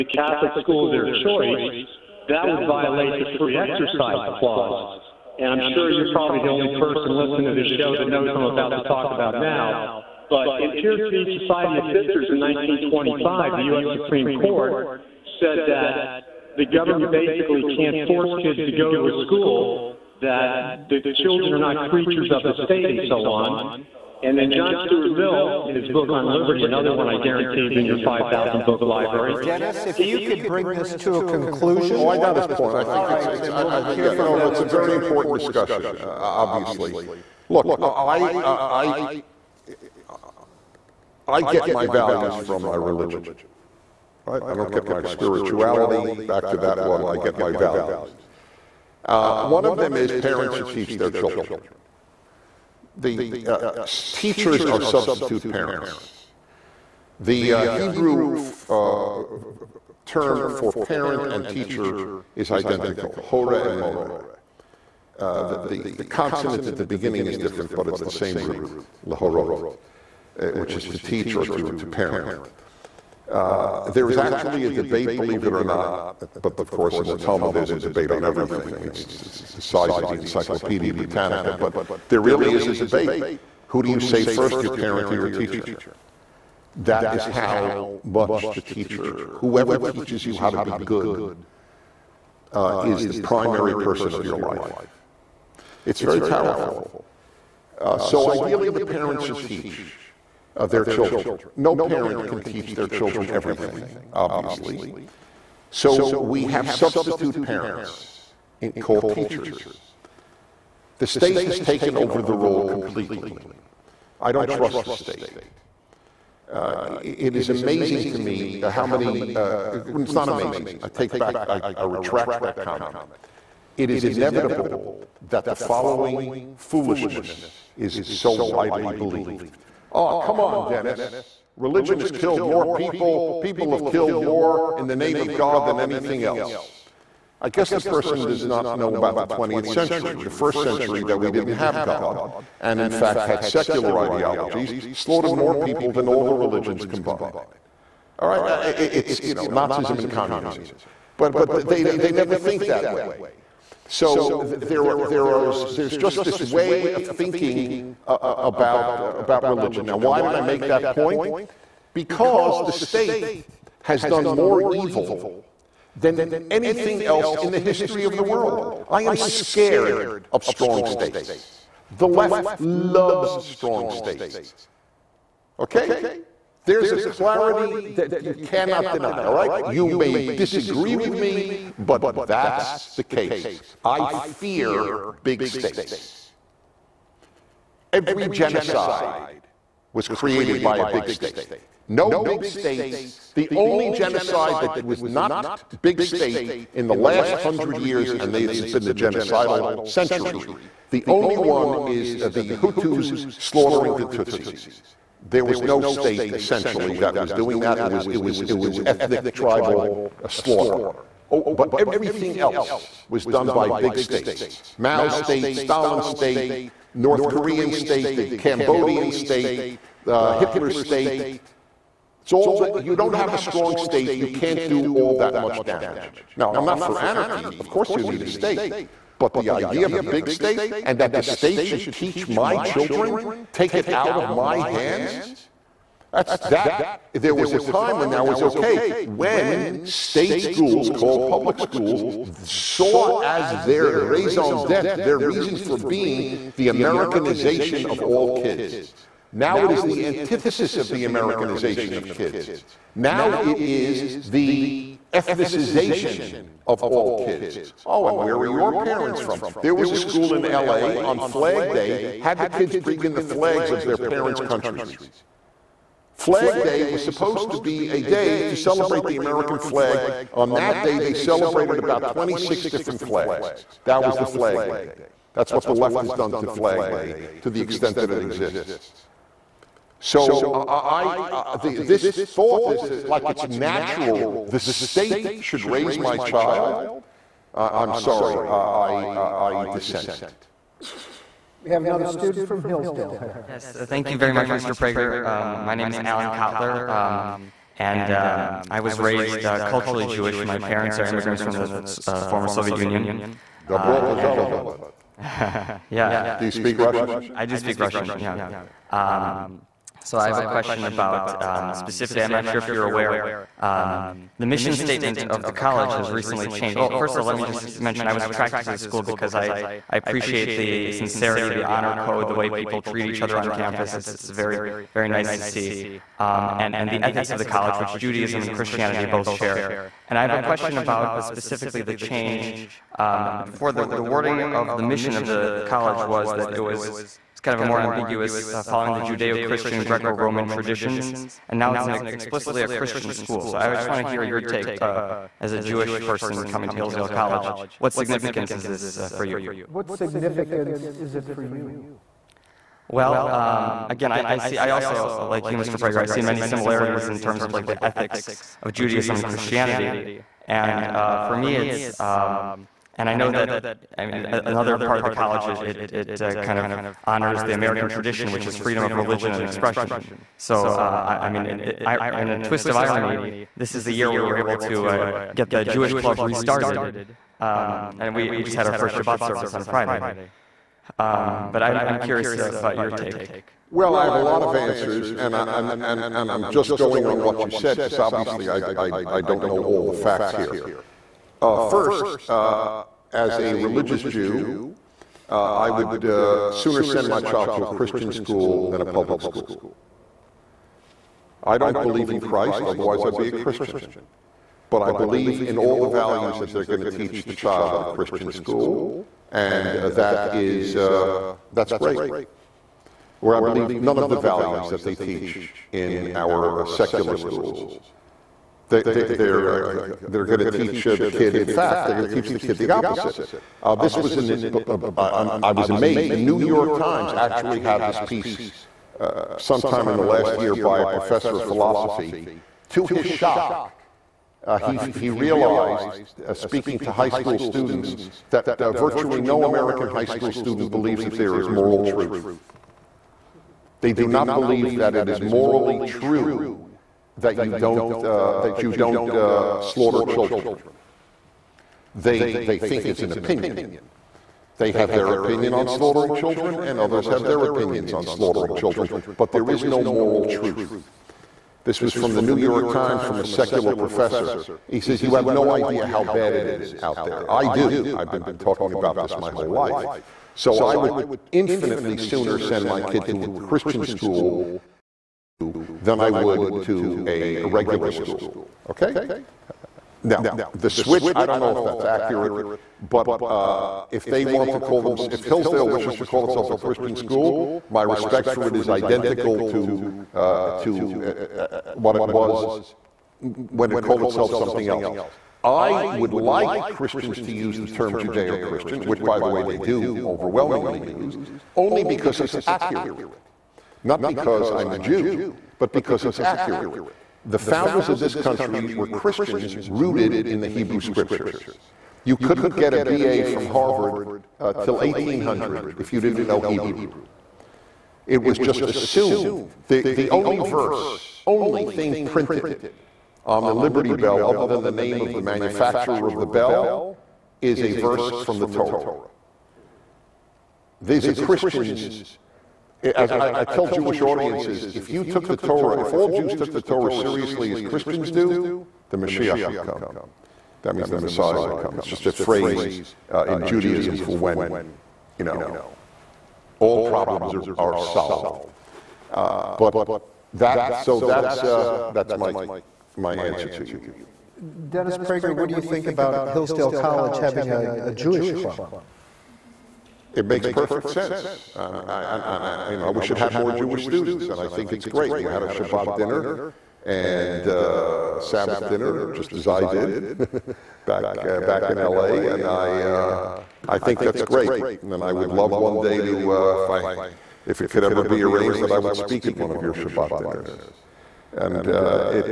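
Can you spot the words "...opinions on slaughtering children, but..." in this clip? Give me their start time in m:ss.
7:37.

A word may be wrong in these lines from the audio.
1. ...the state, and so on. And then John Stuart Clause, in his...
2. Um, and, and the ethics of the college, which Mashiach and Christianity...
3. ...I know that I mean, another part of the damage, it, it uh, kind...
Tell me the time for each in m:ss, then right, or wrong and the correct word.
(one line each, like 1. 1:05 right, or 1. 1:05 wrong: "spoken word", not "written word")
1. 0:22 wrong: "Mill", not "Clause"
2. 5:26 wrong: "Judaism", not "Mashiach"
3. 6:03 wrong: "college", not "damage".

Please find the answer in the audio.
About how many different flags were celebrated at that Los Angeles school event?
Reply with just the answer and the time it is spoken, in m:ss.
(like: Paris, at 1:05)
26, at 4:32.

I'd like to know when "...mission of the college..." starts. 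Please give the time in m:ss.
5:34.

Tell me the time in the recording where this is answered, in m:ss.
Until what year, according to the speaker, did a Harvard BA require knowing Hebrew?
8:34.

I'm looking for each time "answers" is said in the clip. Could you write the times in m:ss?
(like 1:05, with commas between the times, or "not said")
6:24, 9:13.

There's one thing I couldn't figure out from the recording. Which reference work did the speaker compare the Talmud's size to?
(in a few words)
Encyclopedia Britannica.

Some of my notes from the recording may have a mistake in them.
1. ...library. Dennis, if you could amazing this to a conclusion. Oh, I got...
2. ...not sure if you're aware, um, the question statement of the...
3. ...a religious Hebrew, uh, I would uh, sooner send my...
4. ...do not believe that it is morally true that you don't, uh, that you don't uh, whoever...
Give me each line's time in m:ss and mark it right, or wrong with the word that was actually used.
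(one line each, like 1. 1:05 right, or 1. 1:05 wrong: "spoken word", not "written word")
1. 0:28 wrong: "bring", not "amazing"
2. 5:12 wrong: "mission", not "question"
3. 6:33 wrong: "Jew", not "Hebrew"
4. 7:23 wrong: "slaughter", not "whoever".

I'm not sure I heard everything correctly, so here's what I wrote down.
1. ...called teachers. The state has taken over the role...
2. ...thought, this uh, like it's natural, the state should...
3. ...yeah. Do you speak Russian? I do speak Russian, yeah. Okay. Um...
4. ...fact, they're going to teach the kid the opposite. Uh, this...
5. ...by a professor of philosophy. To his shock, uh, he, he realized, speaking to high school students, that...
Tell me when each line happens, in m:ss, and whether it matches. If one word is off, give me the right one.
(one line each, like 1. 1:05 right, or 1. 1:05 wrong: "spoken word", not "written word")
1. 1:48 right
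2. 4:42 right
3. 5:05 right
4. 7:01 right
5. 7:10 right.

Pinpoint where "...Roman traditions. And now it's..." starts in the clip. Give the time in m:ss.
5:40.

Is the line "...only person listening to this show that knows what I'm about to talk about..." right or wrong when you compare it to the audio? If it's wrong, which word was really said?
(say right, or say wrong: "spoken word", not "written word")
right.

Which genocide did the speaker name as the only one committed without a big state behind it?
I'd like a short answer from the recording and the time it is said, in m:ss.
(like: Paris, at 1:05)
Hutus slaughtering the Tutsis, at 3:22.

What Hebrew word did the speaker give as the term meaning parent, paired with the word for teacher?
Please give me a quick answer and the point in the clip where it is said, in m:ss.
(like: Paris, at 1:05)
horeh, at 1:03.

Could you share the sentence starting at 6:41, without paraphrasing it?
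I don't believe in Christ, otherwise, I'd be a Christian.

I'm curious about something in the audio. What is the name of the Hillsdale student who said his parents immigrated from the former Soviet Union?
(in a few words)
Alan Kotler.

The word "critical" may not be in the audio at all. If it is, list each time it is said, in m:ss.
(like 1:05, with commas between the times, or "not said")
not said.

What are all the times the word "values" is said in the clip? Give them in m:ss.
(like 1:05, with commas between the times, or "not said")
0:41, 0:47, 6:45, 6:54.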